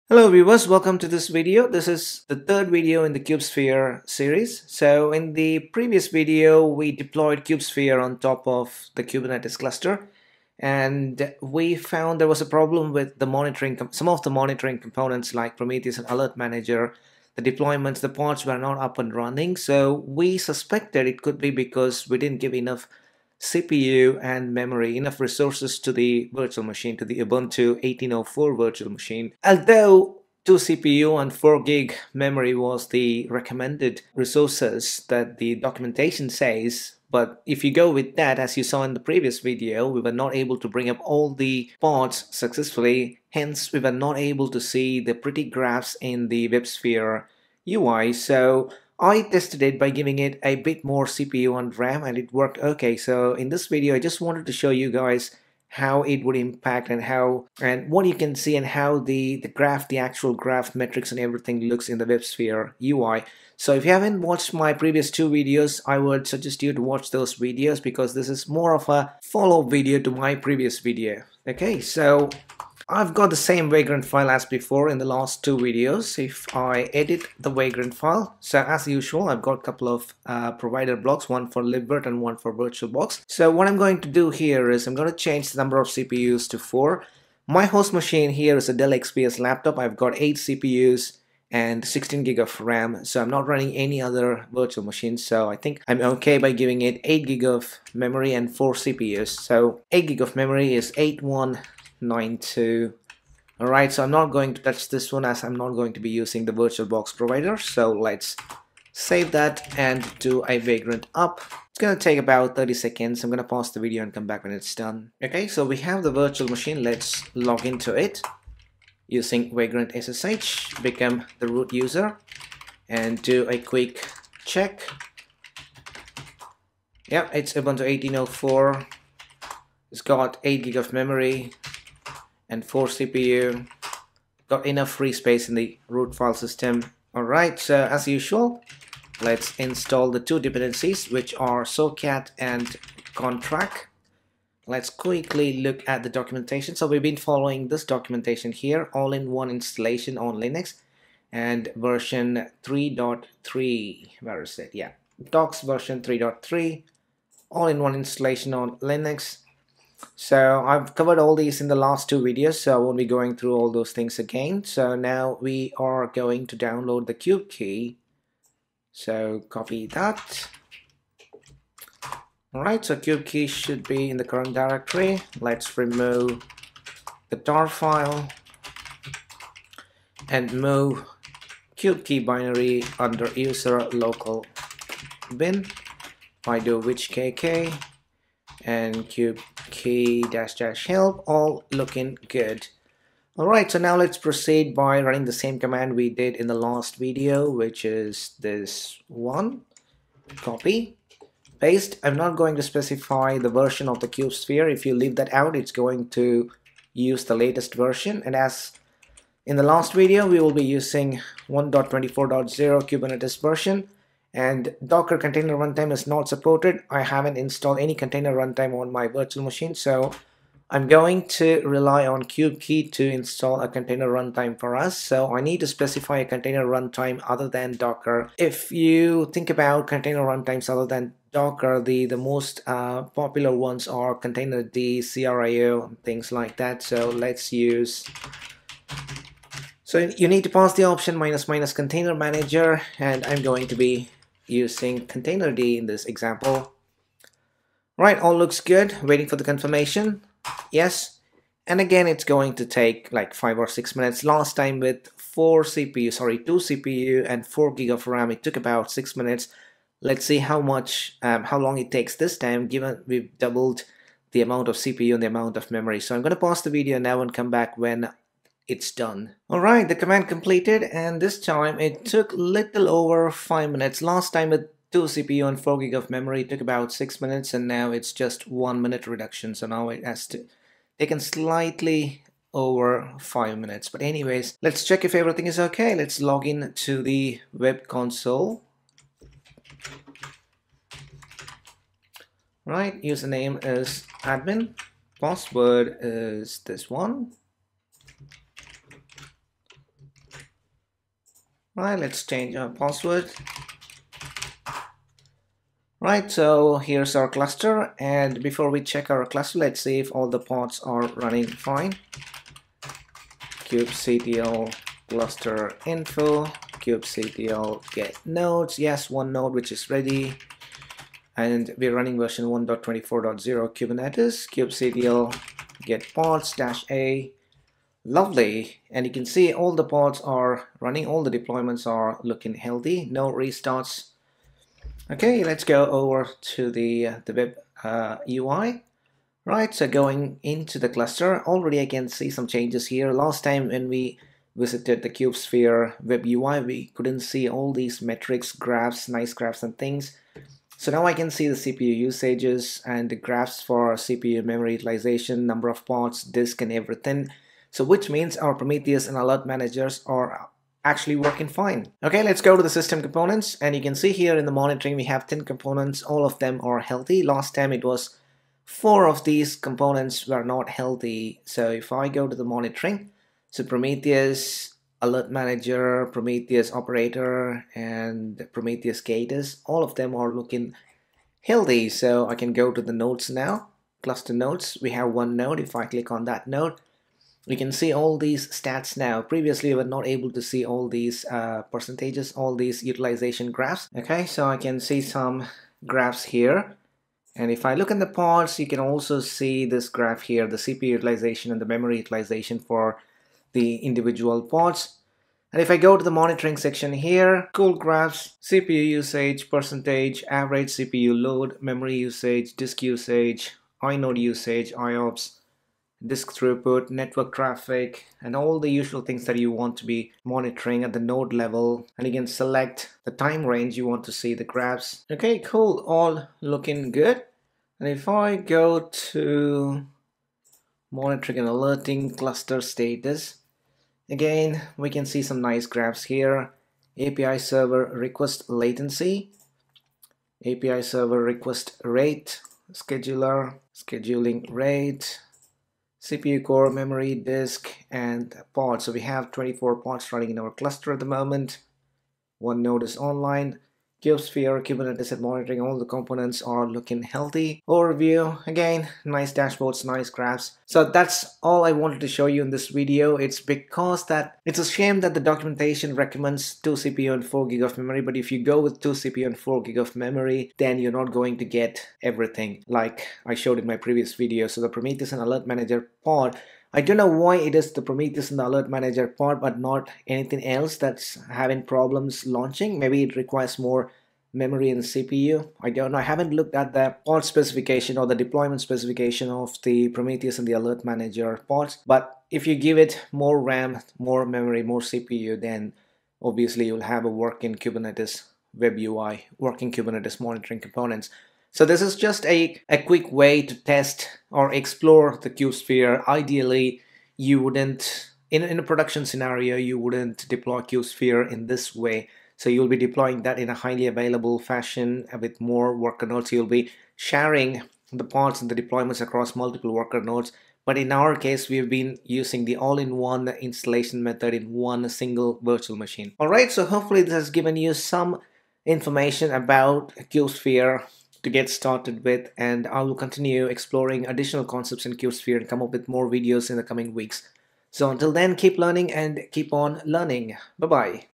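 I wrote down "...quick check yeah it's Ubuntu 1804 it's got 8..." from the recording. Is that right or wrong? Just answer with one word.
right.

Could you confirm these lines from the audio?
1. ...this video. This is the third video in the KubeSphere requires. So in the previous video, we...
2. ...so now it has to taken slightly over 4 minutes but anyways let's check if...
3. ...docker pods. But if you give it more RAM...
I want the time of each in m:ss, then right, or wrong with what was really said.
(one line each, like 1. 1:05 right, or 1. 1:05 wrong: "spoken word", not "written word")
1. 0:01 wrong: "series", not "requires"
2. 4:39 wrong: "5", not "4"
3. 8:10 wrong: "manager", not "docker".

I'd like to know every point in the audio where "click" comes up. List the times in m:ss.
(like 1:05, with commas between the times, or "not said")
6:25.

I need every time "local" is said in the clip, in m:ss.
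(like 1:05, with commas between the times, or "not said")
3:03.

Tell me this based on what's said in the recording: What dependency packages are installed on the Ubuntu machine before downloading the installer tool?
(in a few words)
socat and conntrack.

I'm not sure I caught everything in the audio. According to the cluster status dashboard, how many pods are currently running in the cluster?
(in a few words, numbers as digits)
24.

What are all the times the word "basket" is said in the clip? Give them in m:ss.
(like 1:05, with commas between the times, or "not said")
not said.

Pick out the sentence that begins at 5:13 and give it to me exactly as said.
kubectl cluster info, kubectl get nodes, yes, one node which is ready.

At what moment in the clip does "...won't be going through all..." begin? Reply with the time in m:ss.
2:42.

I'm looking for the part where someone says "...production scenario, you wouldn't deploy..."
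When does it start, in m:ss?
8:28.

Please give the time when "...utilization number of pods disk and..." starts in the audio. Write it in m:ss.
5:54.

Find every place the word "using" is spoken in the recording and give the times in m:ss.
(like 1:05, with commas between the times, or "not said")
1:46, 1:59, 3:30, 4:04, 8:42.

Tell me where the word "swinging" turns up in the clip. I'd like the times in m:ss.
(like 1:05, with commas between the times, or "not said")
not said.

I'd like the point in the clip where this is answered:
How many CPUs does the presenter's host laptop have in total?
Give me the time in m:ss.
1:30.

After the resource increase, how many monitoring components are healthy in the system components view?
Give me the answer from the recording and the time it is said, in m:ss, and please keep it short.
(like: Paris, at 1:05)
10, at 6:05.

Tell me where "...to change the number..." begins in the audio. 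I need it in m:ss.
1:25.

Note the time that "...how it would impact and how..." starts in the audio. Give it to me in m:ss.
0:55.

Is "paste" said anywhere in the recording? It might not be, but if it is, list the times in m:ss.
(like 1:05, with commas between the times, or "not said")
3:21.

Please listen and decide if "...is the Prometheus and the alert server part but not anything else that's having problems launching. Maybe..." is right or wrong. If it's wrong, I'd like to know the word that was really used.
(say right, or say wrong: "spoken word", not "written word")
wrong: "manager", not "server".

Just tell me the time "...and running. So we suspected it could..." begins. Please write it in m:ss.
0:18.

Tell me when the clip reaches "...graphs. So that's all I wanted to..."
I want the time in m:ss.
7:40.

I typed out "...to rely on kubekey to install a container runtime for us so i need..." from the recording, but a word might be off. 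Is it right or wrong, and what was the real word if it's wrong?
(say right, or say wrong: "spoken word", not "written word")
right.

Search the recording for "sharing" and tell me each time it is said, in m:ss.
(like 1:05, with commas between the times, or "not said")
8:36.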